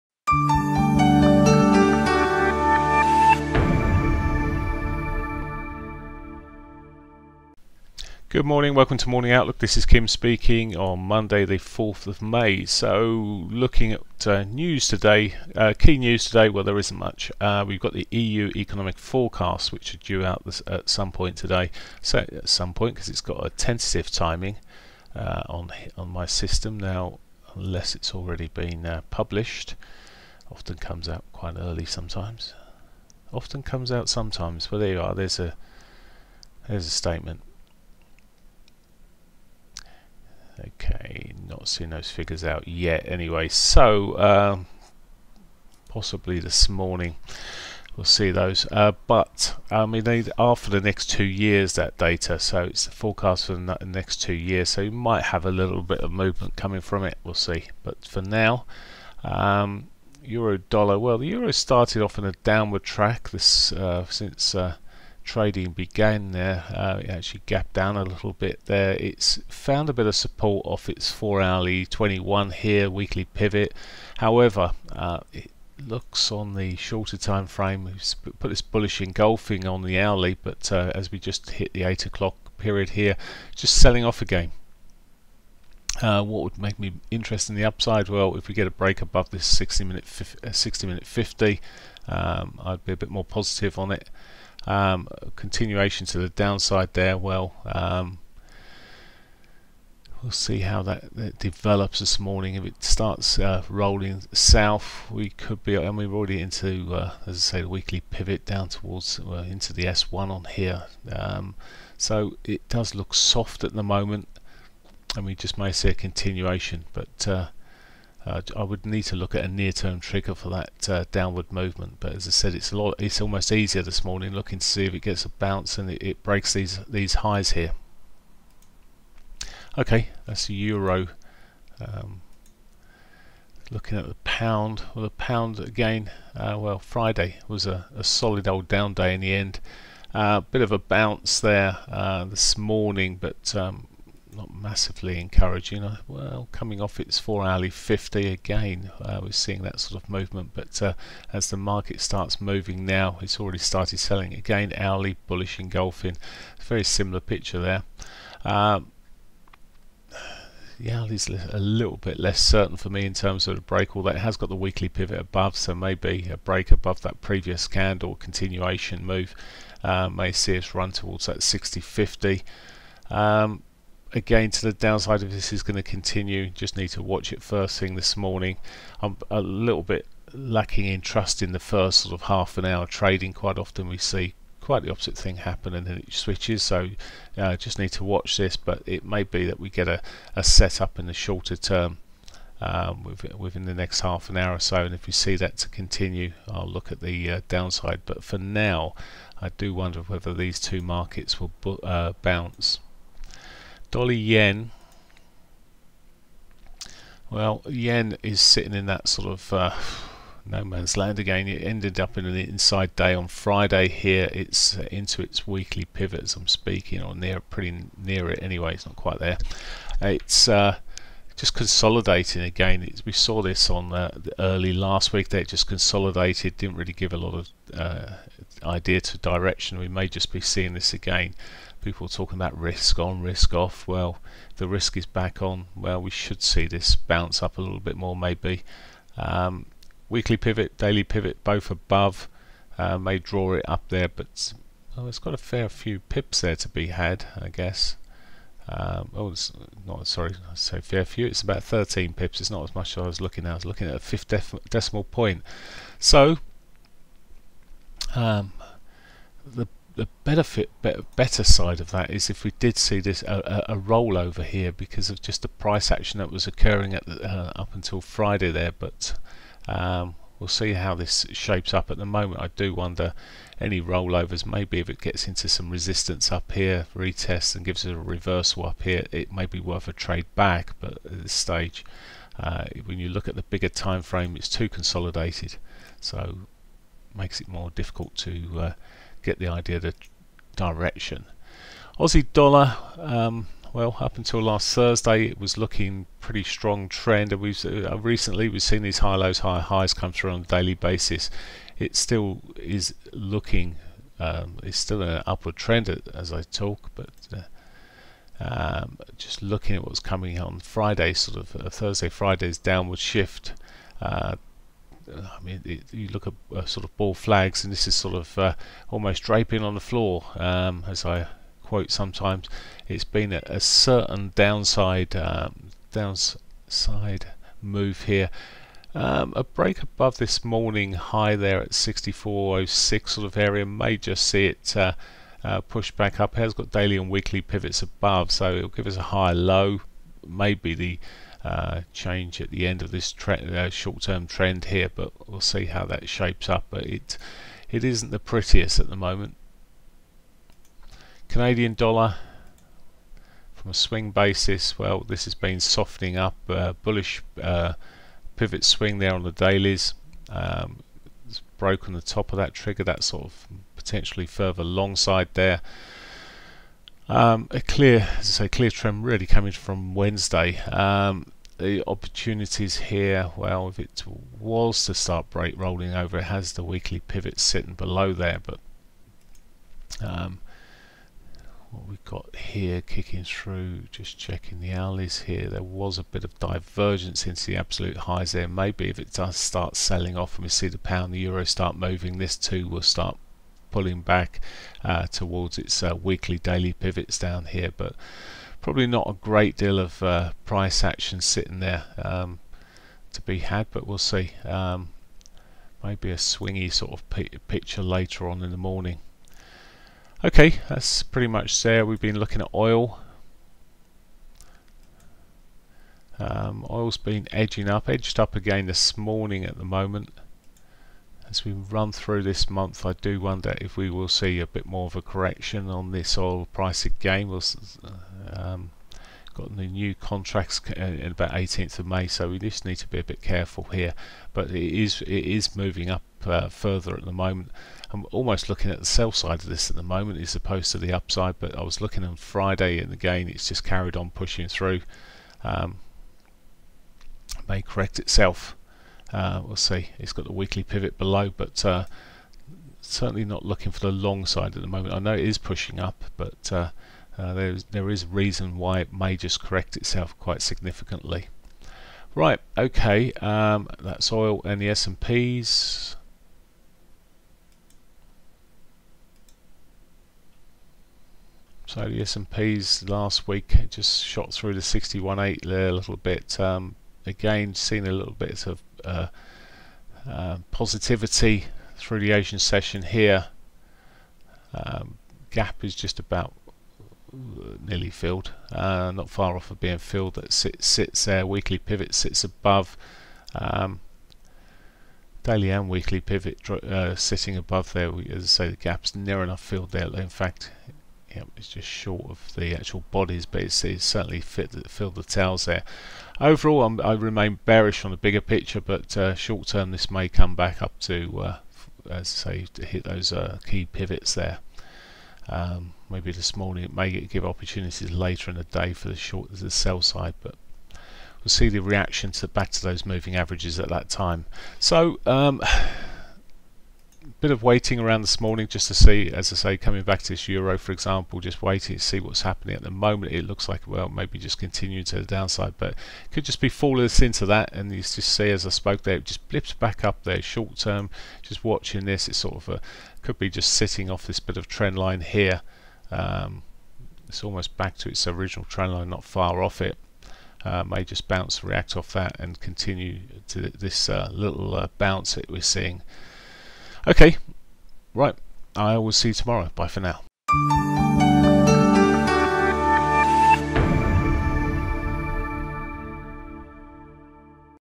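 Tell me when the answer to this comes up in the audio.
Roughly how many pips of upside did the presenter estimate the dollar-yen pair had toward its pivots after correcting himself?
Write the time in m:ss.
4:11.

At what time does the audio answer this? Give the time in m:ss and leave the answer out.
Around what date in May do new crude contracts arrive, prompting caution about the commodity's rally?
7:11.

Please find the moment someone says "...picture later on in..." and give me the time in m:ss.
6:47.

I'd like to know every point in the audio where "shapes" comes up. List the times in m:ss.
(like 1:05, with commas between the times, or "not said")
4:31, 5:46.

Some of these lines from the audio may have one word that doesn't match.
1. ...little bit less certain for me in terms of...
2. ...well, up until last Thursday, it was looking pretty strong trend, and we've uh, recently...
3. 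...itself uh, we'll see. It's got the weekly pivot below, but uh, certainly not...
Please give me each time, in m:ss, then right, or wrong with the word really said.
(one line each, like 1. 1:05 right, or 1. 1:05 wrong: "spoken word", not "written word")
1. 2:41 right
2. 4:53 right
3. 7:27 right.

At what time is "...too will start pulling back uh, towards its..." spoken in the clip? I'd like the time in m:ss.
6:32.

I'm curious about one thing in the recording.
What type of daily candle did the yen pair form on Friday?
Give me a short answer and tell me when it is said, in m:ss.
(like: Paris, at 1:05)
inside day, at 3:32.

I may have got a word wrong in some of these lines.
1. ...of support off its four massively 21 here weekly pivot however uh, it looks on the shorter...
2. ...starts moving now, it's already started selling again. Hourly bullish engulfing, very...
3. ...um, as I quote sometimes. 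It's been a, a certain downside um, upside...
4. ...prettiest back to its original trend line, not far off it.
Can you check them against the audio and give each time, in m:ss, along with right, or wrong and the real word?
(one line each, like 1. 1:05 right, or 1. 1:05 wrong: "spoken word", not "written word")
1. 1:10 wrong: "hourly", not "massively"
2. 2:32 right
3. 5:20 wrong: "downside", not "upside"
4. 9:07 wrong: "almost", not "prettiest".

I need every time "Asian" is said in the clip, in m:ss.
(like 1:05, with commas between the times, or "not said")
8:02.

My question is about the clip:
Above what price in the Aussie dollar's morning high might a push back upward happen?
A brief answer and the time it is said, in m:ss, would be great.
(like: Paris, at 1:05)
64.06, at 5:31.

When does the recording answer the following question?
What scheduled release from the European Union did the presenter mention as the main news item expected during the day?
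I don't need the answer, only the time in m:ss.
0:18.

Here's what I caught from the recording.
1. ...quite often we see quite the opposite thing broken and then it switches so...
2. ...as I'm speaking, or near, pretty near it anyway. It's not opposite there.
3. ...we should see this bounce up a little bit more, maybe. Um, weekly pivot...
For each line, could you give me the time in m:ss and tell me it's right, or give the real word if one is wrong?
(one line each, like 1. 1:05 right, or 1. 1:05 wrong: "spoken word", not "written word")
1. 3:03 wrong: "happen", not "broken"
2. 3:36 wrong: "quite", not "opposite"
3. 3:56 right.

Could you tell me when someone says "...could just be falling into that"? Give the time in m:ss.
8:56.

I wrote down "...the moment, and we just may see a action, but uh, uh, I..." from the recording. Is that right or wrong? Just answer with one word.
wrong.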